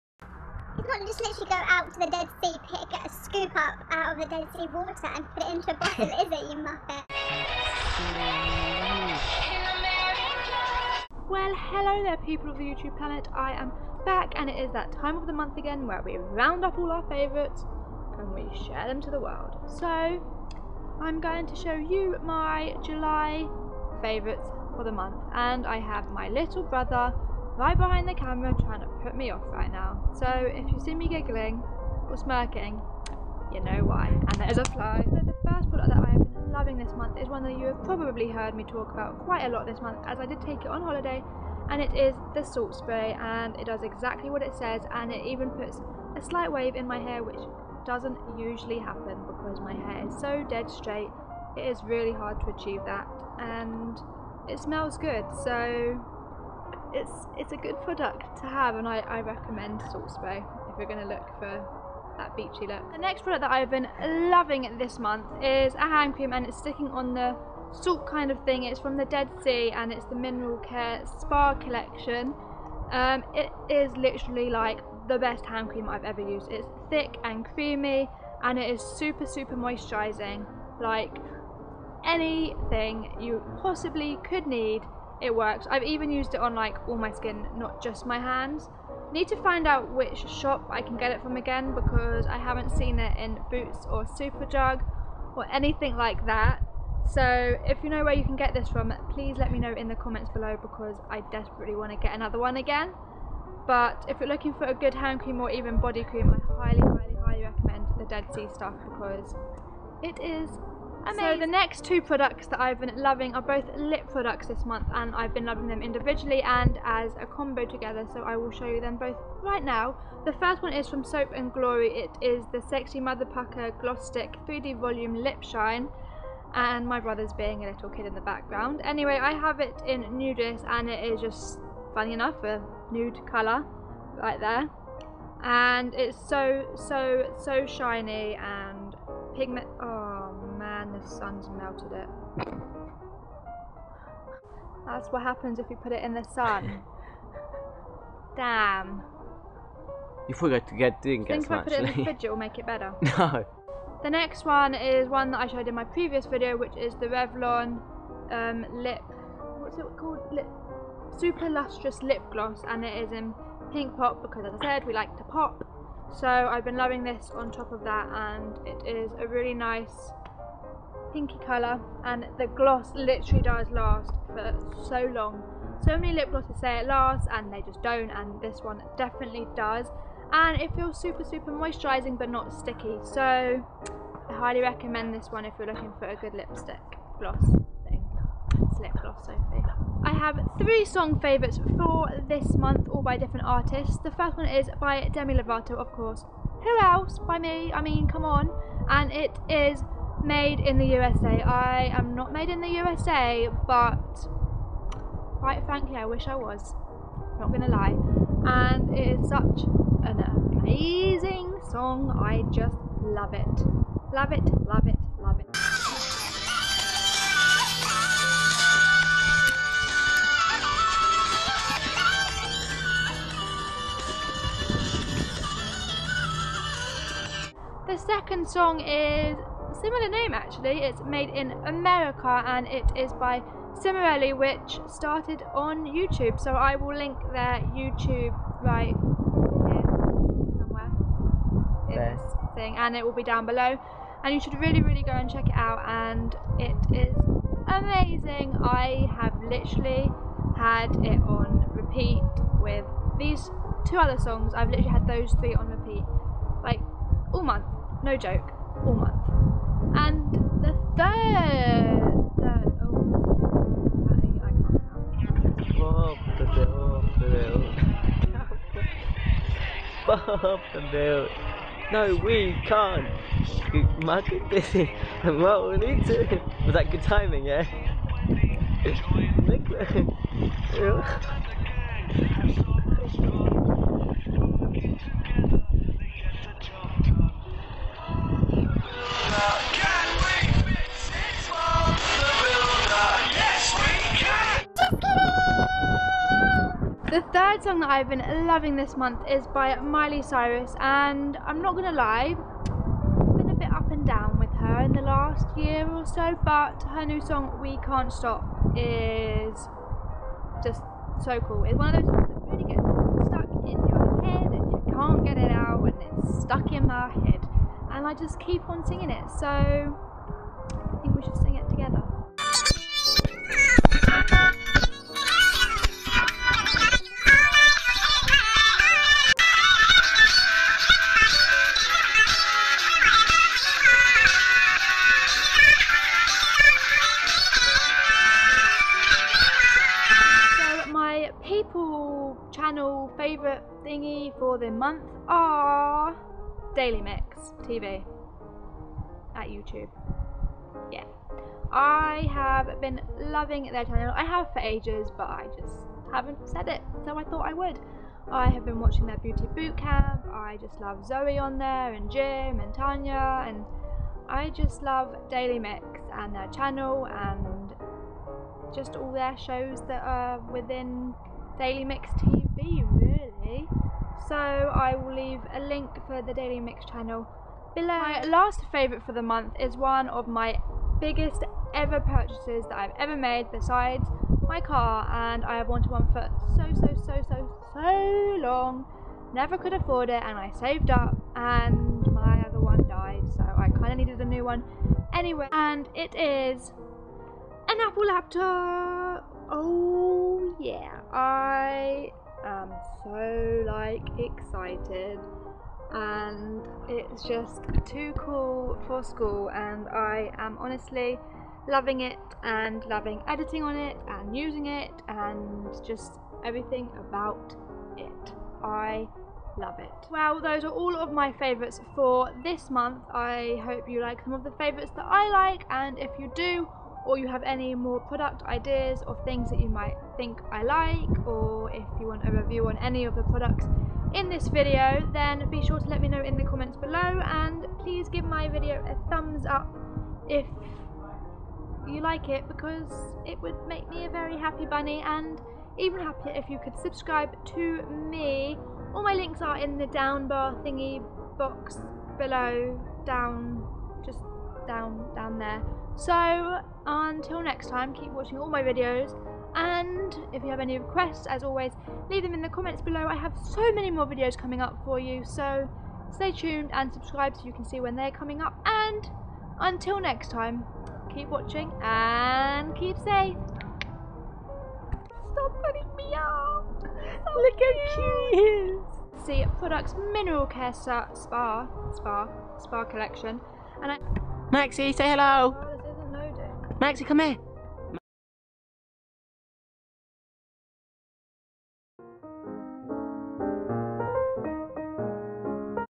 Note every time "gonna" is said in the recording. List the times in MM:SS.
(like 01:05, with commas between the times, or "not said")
03:27, 05:01.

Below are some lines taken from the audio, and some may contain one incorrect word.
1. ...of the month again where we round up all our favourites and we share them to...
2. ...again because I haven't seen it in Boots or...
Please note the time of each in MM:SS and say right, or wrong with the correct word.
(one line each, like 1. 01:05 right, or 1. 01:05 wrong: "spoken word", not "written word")
1. 00:15 right
2. 01:31 right.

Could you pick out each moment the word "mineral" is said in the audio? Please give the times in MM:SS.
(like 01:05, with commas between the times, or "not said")
01:10, 08:00.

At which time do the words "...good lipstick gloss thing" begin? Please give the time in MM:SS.
03:06.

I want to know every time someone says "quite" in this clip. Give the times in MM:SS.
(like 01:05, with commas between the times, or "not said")
00:39, 03:25.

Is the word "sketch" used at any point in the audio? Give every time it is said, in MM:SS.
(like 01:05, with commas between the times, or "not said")
not said.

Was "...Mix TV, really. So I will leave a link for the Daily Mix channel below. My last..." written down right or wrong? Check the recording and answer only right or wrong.
right.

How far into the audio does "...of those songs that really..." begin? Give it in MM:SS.
05:11.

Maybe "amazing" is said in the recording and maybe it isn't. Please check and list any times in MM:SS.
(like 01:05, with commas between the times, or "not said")
01:51, 03:30, 04:07.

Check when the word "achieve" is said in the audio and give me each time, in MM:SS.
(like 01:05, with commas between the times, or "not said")
00:52.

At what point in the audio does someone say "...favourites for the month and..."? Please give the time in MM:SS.
00:24.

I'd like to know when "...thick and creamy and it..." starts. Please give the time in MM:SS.
01:16.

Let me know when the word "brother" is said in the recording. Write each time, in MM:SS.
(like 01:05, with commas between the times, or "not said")
00:26, 02:06.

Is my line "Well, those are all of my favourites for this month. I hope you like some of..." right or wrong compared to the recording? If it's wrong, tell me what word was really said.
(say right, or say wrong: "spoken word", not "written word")
right.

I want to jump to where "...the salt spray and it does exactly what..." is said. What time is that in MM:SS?
00:42.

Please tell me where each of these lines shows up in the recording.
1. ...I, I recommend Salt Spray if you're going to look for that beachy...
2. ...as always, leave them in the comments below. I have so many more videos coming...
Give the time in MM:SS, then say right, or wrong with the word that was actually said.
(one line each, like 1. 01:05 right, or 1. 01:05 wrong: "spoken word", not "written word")
1. 00:58 right
2. 07:41 right.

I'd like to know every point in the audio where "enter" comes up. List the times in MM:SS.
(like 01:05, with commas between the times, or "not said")
not said.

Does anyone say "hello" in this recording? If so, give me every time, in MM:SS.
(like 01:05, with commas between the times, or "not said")
00:11, 08:05.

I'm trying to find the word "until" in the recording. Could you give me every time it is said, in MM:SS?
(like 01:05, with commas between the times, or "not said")
07:36, 07:49.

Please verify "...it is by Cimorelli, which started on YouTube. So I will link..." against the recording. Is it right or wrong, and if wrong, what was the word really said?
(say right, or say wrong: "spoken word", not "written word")
right.